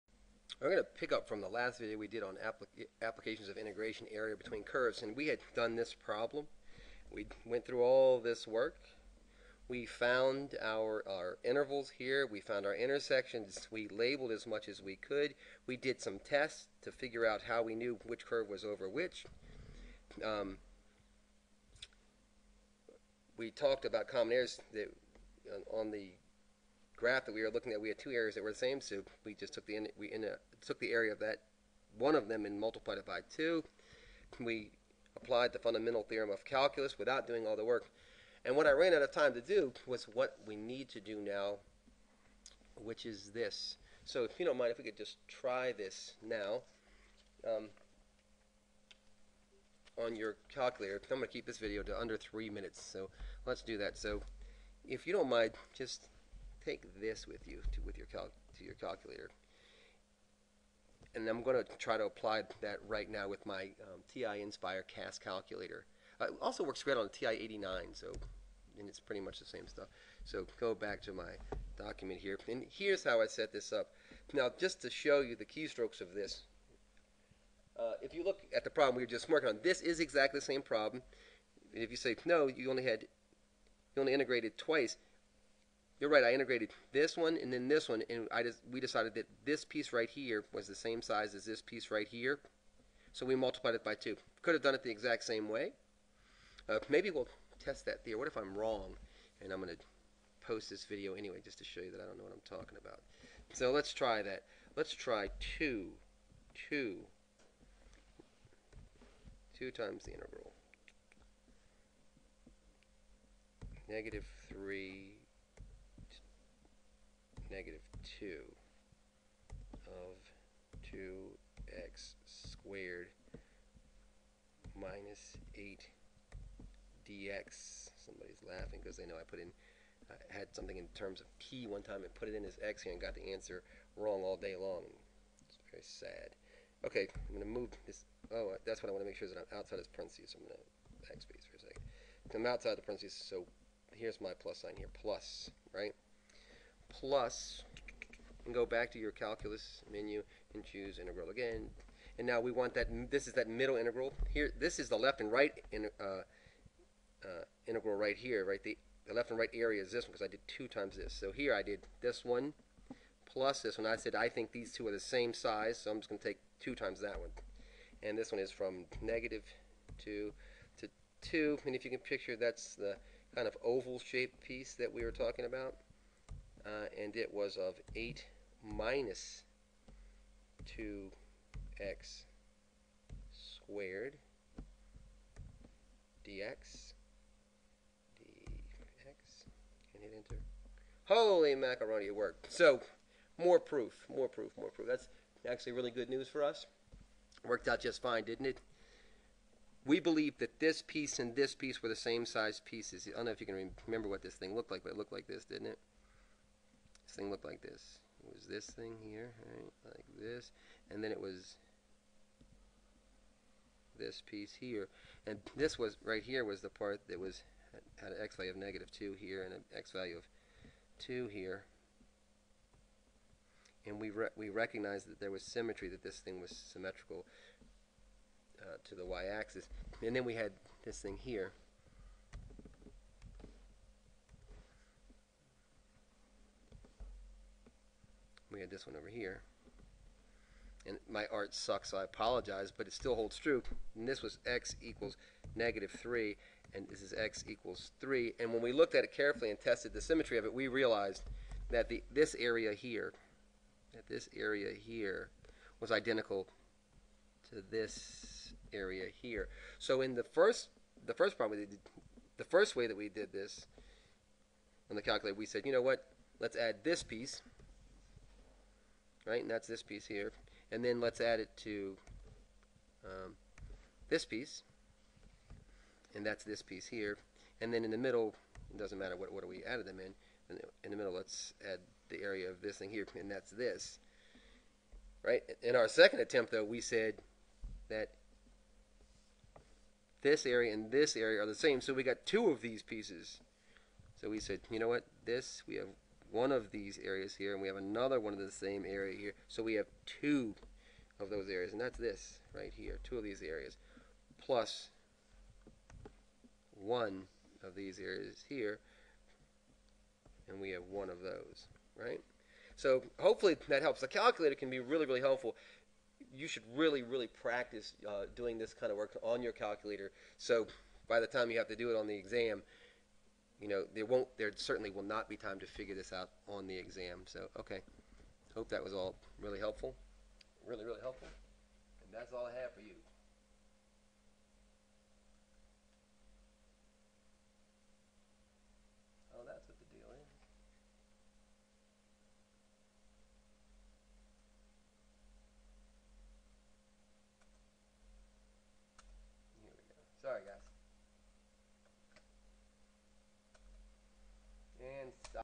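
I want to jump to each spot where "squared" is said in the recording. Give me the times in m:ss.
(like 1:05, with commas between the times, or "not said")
2:02, 3:03.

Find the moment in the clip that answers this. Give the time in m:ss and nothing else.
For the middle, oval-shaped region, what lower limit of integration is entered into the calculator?
2:49.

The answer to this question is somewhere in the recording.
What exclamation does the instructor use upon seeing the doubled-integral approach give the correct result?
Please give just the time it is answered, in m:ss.
3:11.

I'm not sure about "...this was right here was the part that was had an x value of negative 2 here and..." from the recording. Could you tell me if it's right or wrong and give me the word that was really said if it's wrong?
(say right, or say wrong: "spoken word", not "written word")
right.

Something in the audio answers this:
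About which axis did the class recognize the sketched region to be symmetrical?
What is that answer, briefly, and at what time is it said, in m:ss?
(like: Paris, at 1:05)
y-axis, at 3:49.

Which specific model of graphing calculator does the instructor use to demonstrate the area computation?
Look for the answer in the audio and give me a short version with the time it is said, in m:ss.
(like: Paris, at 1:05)
TI Nspire CAS, at 1:04.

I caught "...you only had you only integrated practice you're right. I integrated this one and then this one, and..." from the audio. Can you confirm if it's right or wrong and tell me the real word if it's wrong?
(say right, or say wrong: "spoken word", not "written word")
wrong: "twice", not "practice".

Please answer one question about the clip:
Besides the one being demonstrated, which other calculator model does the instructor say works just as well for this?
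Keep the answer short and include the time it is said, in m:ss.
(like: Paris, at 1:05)
TI 89, at 1:07.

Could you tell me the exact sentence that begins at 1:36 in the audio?
Uh, maybe we'll test that theory.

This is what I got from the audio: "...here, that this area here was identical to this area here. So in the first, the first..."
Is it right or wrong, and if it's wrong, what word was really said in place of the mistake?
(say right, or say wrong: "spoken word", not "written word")
right.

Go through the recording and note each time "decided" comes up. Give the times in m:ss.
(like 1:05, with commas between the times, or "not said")
1:28.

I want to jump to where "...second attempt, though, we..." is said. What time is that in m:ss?
4:45.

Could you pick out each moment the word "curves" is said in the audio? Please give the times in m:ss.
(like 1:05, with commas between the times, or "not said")
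0:04, 0:18.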